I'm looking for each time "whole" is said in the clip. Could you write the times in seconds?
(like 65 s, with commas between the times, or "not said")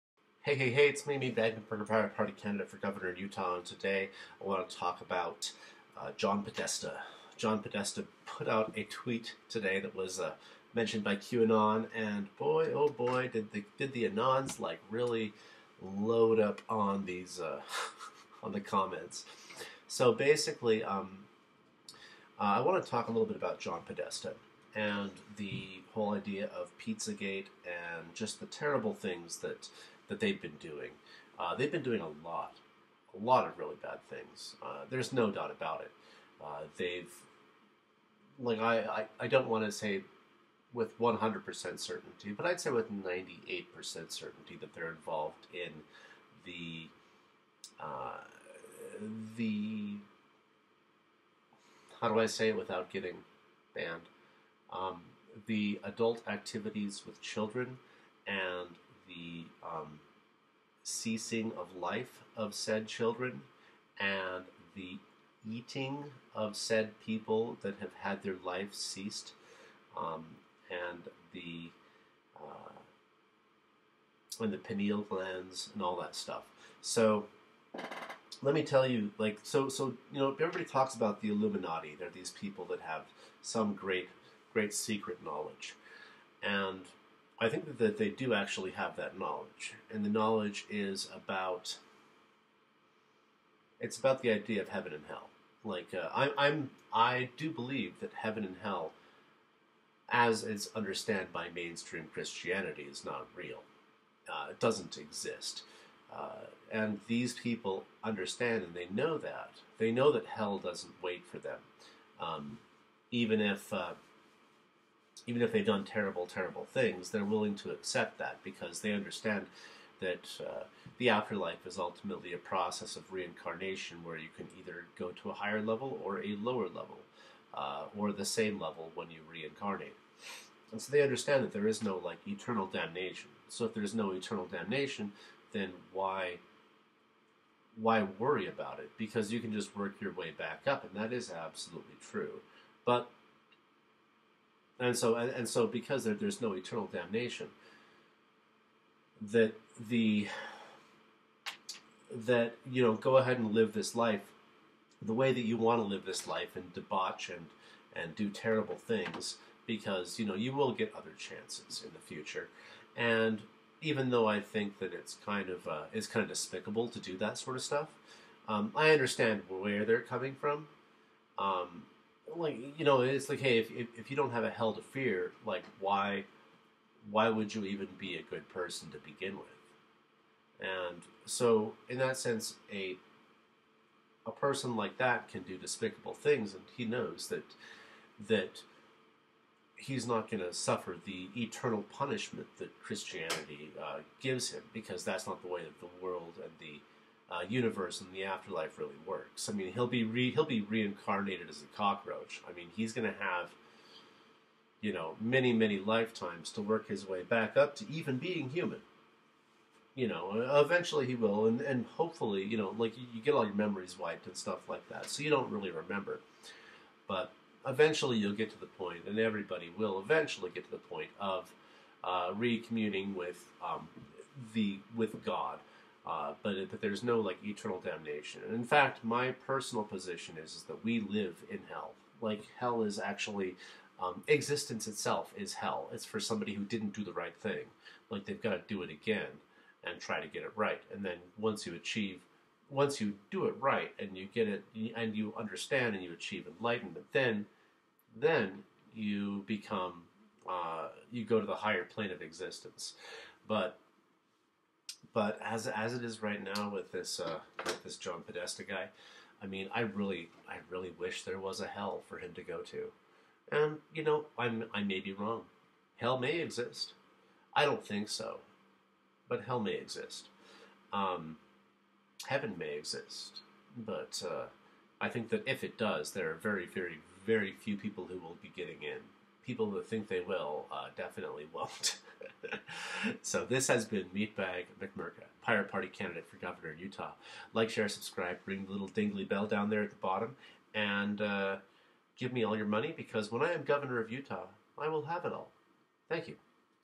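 25 s.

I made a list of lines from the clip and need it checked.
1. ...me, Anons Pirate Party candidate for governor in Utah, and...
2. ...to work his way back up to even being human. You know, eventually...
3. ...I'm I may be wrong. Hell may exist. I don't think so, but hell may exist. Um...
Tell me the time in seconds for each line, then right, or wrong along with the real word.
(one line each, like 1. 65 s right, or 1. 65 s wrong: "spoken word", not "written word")
1. 1 s wrong: "Bagman", not "Anons"
2. 206 s right
3. 264 s right.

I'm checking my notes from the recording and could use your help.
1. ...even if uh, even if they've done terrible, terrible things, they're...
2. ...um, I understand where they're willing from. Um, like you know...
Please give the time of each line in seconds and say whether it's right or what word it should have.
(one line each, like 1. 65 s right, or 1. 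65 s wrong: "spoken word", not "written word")
1. 113 s right
2. 168 s wrong: "coming", not "willing".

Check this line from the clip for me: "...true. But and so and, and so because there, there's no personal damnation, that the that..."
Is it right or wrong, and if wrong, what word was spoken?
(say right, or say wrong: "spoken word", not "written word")
wrong: "eternal", not "personal".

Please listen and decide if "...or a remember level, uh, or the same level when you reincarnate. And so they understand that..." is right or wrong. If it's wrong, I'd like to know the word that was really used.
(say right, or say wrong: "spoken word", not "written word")
wrong: "lower", not "remember".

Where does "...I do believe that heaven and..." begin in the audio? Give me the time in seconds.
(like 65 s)
96 s.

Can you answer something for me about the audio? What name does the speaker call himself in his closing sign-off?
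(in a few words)
Meatbag McMurka.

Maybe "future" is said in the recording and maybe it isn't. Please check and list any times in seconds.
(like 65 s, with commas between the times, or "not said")
161 s.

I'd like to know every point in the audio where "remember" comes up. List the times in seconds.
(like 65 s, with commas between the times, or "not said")
215 s.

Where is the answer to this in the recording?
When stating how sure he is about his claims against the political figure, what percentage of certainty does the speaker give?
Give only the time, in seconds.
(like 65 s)
42 s.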